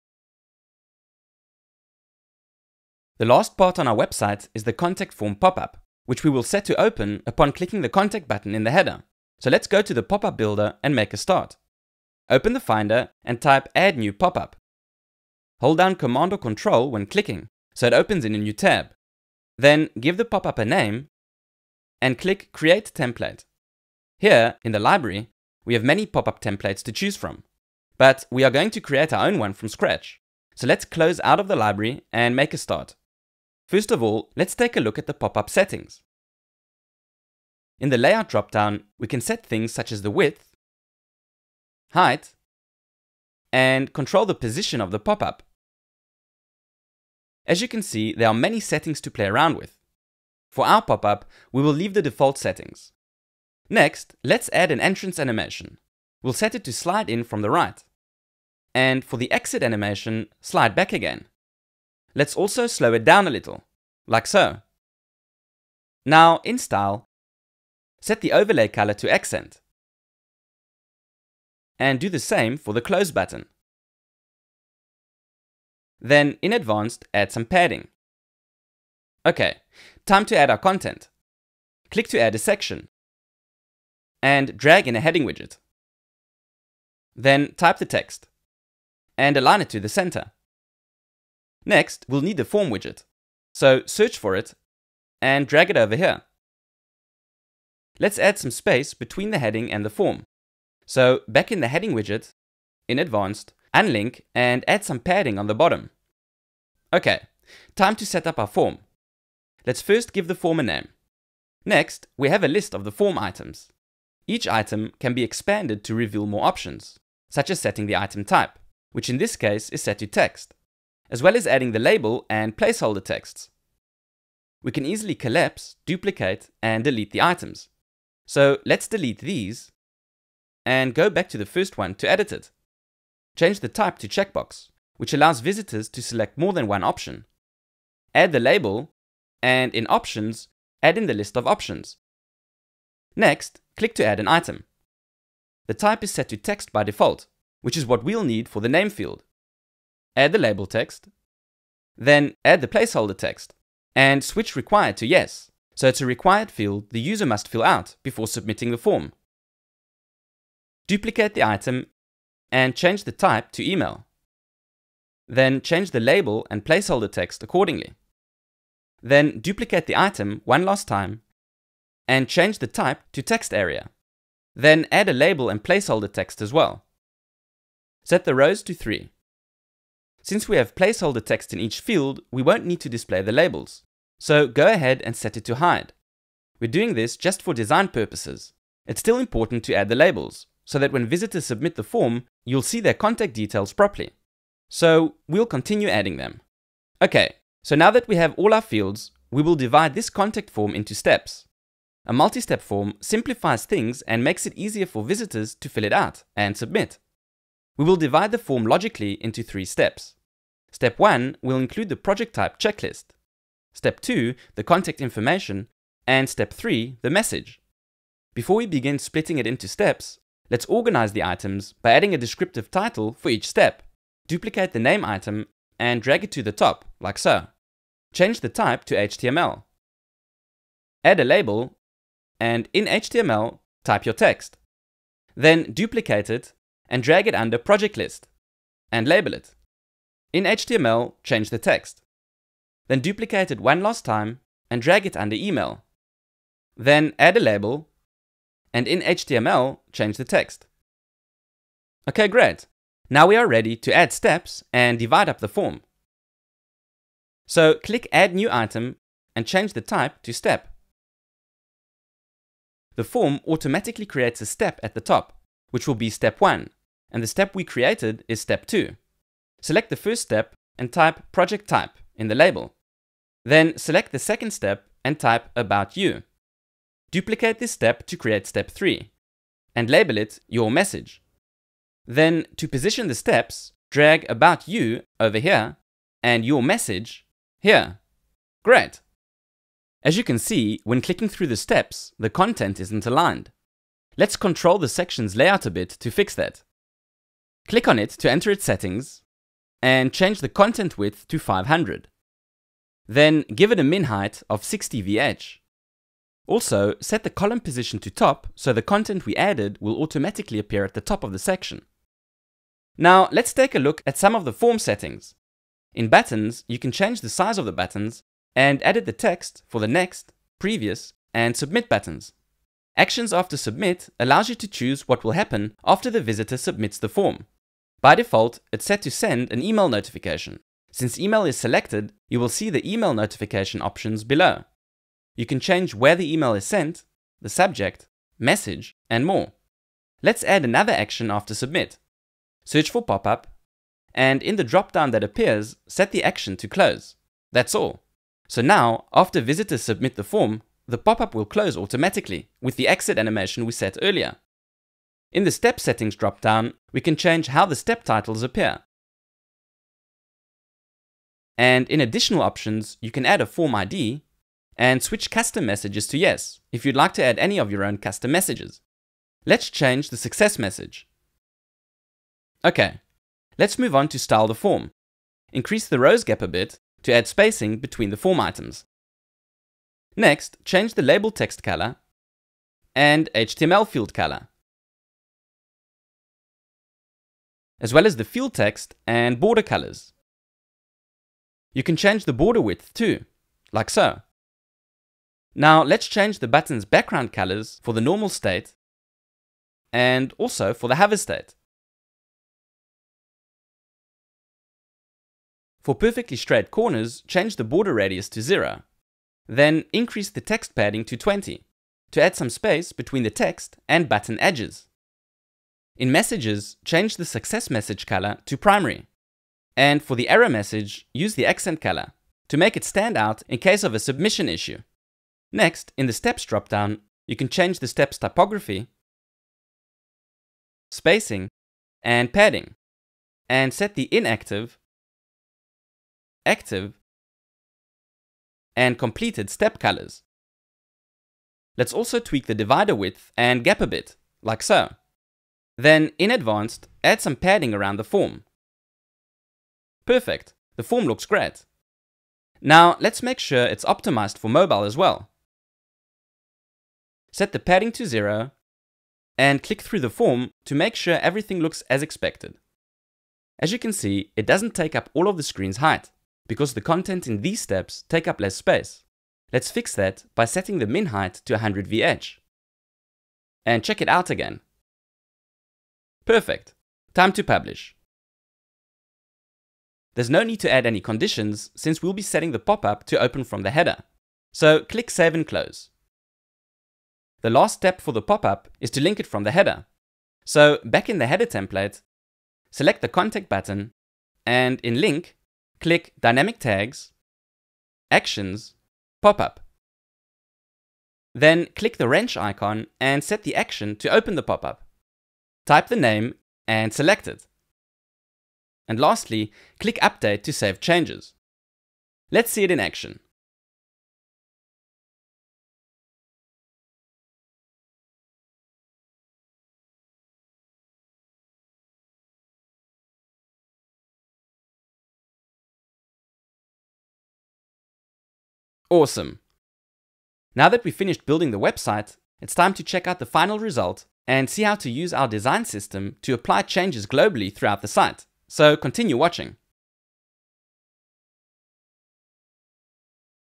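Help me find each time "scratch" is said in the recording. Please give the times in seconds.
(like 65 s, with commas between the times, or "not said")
29 s.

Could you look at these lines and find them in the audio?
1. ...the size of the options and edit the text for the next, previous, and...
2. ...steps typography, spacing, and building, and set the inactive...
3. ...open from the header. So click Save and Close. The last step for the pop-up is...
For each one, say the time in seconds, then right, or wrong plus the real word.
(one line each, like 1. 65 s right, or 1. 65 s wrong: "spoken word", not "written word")
1. 317 s wrong: "buttons", not "options"
2. 427 s wrong: "padding", not "building"
3. 483 s right.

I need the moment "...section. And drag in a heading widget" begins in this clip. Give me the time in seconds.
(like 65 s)
82 s.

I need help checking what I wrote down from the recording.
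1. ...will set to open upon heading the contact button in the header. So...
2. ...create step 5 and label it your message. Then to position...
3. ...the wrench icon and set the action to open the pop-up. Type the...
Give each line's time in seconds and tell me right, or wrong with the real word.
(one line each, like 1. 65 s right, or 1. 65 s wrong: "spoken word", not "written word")
1. 6 s wrong: "clicking", not "heading"
2. 278 s wrong: "3", not "5"
3. 501 s right.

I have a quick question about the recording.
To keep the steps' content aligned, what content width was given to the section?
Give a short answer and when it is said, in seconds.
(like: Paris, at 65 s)
500, at 301 s.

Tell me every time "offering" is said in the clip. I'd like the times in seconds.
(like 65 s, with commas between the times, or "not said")
not said.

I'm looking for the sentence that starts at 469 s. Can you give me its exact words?
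Let's fix that by setting the min height to 100 VH.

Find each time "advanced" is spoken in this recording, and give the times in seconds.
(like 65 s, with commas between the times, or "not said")
76 s, 102 s, 446 s.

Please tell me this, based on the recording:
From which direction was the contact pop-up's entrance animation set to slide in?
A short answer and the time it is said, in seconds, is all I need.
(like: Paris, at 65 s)
From the right, at 57 s.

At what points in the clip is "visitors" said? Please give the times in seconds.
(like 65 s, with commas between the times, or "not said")
135 s, 191 s, 205 s, 326 s, 349 s.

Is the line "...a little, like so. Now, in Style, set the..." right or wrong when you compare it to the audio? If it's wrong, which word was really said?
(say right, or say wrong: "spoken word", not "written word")
right.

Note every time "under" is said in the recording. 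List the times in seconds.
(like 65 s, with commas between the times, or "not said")
237 s, 245 s.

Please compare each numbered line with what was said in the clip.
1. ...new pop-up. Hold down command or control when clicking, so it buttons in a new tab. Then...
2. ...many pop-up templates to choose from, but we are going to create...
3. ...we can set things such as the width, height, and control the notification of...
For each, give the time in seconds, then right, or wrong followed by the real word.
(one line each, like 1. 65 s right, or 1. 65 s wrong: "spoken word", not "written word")
1. 13 s wrong: "opens", not "buttons"
2. 25 s right
3. 38 s wrong: "position", not "notification".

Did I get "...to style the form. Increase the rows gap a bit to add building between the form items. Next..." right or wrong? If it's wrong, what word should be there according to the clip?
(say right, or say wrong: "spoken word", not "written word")
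wrong: "spacing", not "building".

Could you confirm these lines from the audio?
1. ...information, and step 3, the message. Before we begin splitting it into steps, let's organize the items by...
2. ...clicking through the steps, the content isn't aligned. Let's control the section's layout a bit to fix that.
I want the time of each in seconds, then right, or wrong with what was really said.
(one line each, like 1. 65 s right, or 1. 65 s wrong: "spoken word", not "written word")
1. 215 s right
2. 291 s right.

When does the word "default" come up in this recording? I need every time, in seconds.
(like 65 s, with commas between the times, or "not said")
52 s, 146 s, 328 s.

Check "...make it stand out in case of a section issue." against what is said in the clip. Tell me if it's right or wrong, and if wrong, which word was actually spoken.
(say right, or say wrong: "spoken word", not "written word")
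wrong: "submission", not "section".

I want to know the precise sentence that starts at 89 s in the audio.
And align it to the center.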